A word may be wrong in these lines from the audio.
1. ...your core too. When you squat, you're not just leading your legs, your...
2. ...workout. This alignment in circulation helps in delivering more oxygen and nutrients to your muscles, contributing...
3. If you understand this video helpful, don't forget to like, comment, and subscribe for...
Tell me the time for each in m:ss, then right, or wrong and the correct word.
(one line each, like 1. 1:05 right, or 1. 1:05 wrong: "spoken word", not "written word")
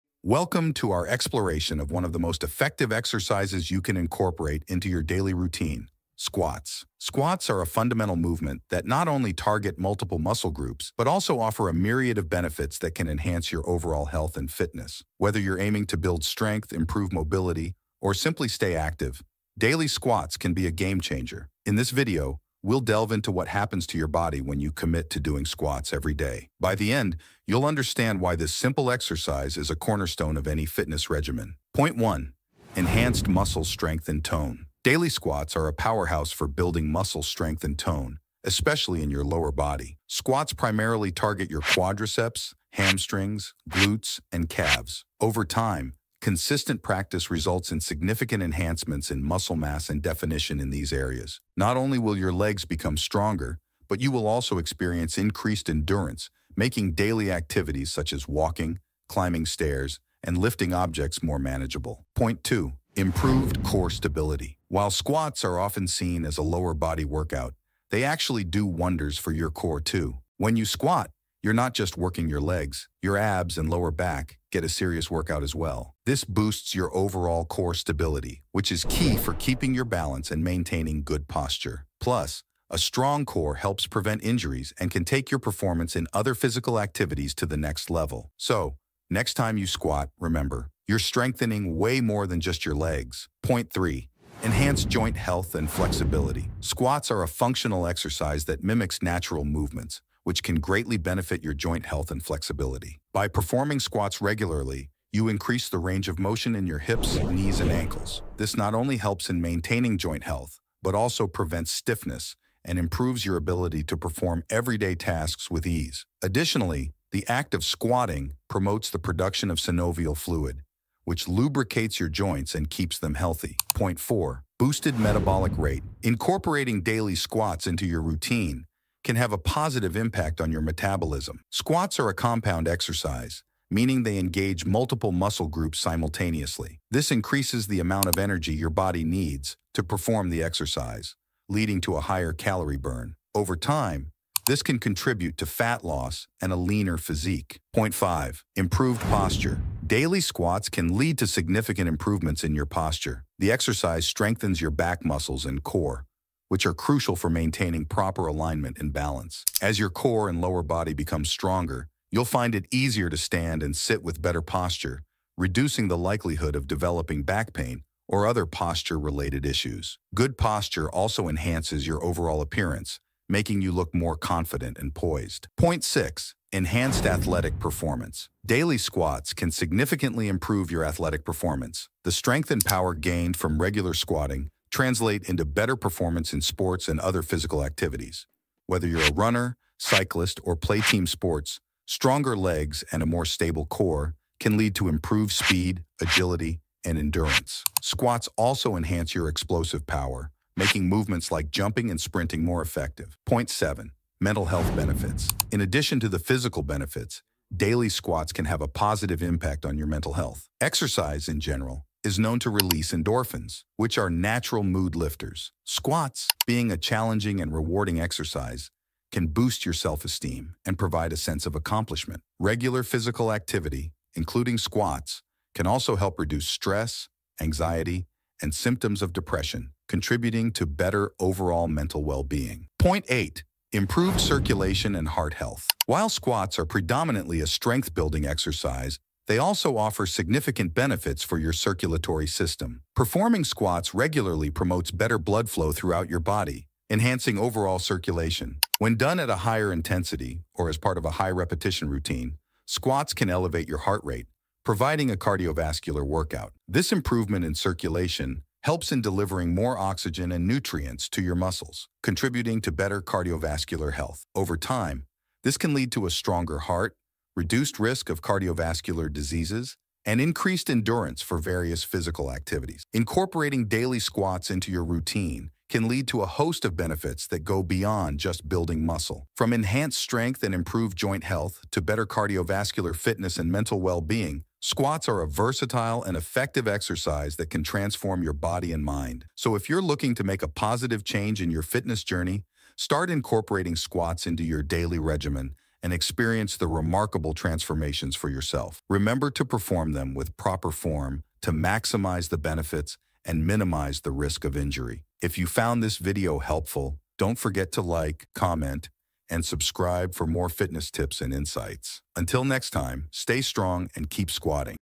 1. 1:09 wrong: "working", not "leading"
2. 4:16 wrong: "improvement", not "alignment"
3. 5:05 wrong: "found", not "understand".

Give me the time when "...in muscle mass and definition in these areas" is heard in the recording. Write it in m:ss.
0:49.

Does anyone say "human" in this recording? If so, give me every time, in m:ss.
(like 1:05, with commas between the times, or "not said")
not said.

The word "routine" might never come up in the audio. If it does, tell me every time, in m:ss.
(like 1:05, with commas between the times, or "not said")
0:05, 2:08, 4:11, 4:34.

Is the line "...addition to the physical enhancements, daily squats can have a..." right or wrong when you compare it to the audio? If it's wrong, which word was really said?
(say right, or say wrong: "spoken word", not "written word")
wrong: "benefits", not "enhancements".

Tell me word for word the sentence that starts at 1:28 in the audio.
So, next time you squat, remember, you're strengthening way more than just your legs.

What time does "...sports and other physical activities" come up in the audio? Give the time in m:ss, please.
3:06.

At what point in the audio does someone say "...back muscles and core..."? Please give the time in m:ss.
2:34.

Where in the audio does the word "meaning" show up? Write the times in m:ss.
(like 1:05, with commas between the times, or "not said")
2:13.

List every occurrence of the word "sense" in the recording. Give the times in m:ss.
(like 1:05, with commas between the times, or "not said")
3:41.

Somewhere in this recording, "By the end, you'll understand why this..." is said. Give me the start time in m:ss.
0:26.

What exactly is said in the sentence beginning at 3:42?
Regular physical activity, including squats, can also help reduce stress, anxiety, and symptoms of depression, contributing to better overall mental well-being.